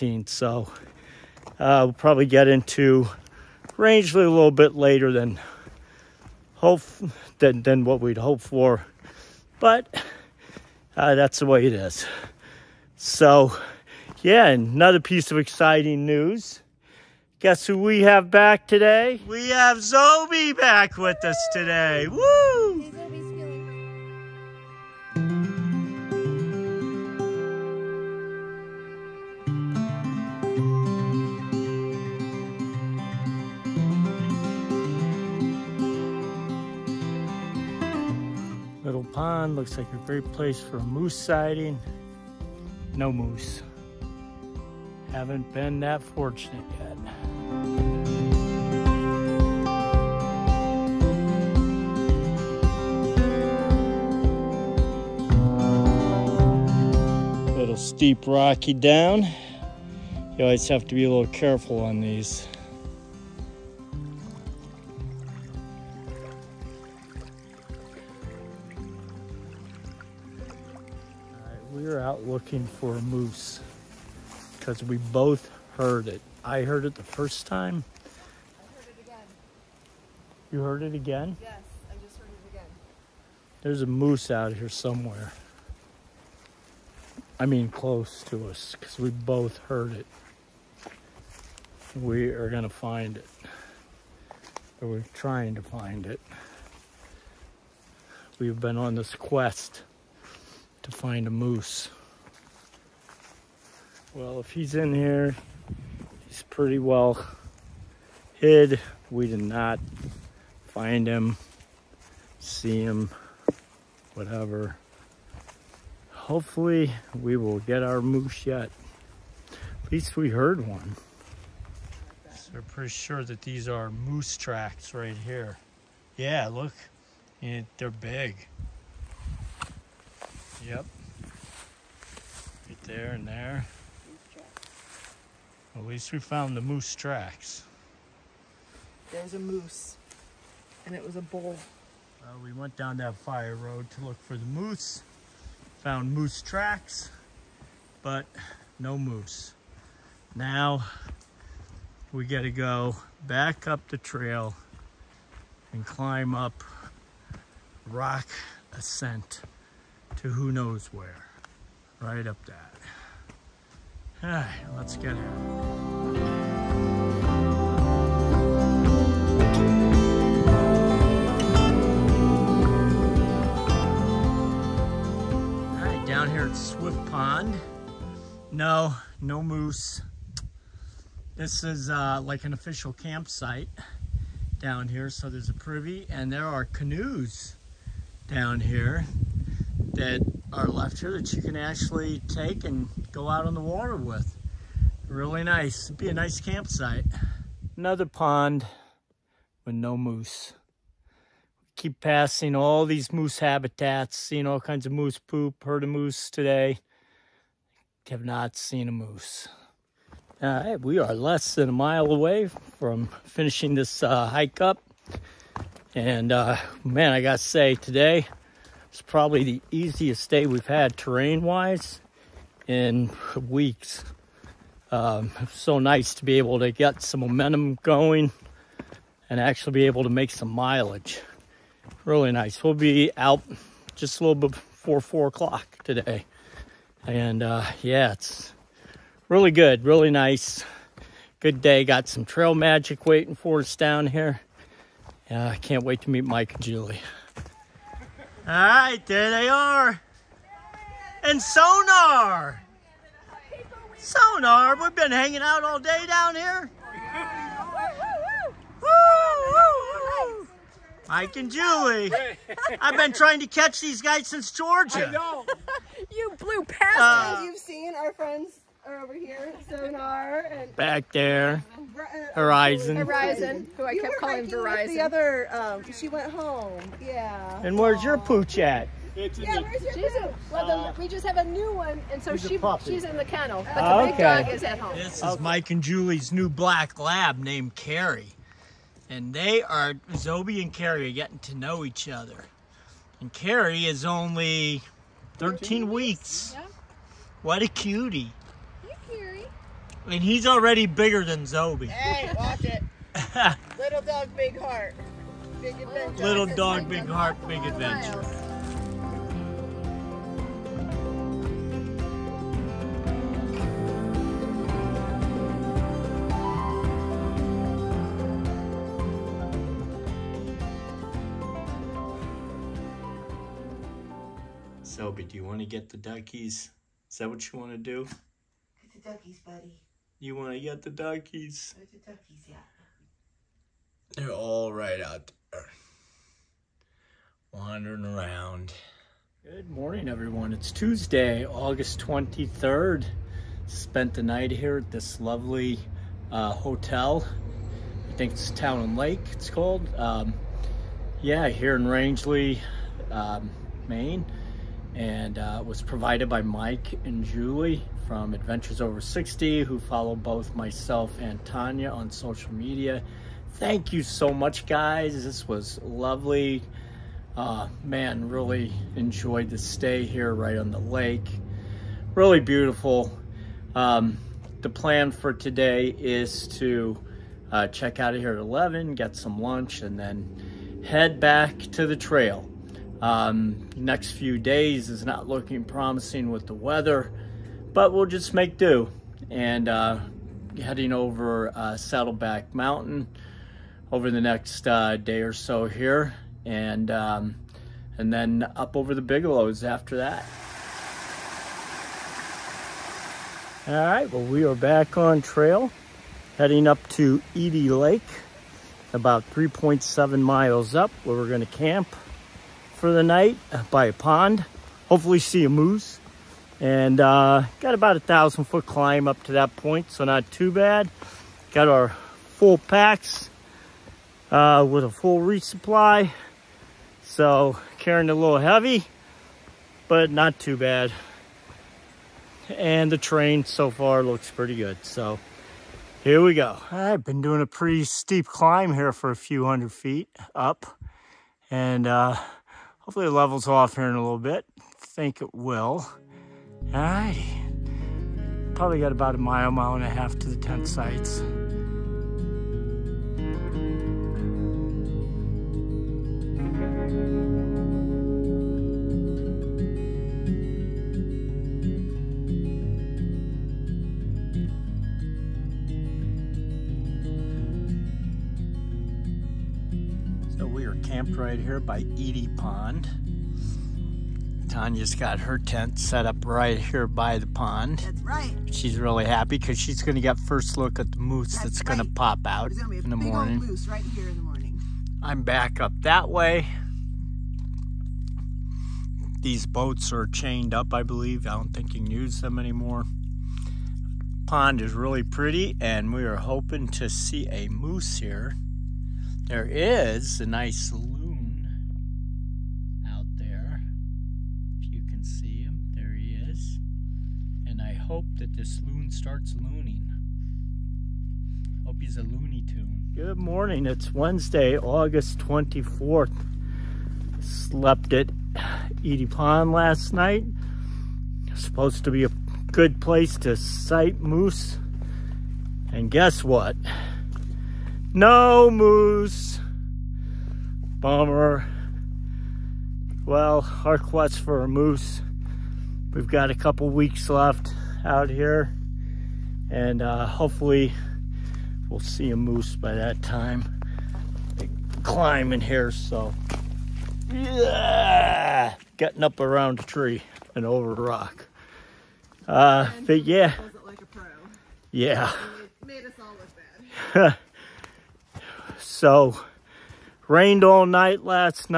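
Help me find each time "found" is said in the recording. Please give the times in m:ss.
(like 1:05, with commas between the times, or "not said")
2:16, 2:25.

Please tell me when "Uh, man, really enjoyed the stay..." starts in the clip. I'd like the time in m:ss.
6:07.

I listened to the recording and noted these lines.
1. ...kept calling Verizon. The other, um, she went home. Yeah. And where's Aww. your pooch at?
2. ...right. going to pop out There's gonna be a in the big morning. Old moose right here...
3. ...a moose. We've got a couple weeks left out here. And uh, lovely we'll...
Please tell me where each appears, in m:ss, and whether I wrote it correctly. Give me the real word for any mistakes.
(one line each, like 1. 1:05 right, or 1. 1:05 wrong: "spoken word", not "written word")
1. 4:34 right
2. 8:01 right
3. 8:54 wrong: "hopefully", not "lovely".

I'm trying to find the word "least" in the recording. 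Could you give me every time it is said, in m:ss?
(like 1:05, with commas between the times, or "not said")
1:59, 2:15.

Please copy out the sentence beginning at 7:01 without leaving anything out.
Got our full packs uh, with a full resupply.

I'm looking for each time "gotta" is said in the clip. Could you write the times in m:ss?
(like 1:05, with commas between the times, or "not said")
2:32, 3:37.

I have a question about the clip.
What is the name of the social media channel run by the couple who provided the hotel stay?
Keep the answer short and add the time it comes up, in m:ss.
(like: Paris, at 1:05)
Adventures Over 60, at 5:58.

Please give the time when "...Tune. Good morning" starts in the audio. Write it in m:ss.
8:32.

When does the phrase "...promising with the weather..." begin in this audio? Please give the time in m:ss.
6:25.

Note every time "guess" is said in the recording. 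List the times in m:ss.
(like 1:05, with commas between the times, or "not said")
0:17, 8:45.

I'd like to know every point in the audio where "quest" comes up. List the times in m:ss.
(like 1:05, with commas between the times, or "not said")
1:39, 8:53.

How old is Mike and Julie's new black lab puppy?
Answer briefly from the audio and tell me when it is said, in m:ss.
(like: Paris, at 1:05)
13 weeks, at 4:55.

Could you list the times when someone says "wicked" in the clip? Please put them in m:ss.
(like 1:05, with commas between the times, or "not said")
not said.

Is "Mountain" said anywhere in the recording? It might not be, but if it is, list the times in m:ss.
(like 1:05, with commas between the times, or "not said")
6:32.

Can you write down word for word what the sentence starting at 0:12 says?
So, yeah, another piece of exciting news.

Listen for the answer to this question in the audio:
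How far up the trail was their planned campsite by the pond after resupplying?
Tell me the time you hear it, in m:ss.
6:49.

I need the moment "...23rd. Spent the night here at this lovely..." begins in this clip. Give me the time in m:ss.
5:41.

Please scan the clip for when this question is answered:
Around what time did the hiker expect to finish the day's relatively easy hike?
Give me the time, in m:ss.
3:54.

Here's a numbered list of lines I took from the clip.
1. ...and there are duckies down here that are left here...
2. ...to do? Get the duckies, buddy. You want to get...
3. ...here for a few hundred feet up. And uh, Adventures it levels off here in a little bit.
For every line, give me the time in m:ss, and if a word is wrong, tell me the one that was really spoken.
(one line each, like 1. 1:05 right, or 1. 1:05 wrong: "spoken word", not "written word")
1. 3:06 wrong: "canoes", not "duckies"
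2. 5:27 right
3. 7:18 wrong: "Hopefully", not "Adventures".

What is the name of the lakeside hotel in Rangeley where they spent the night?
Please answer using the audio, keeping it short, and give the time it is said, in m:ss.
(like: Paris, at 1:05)
Town and Lake, at 5:48.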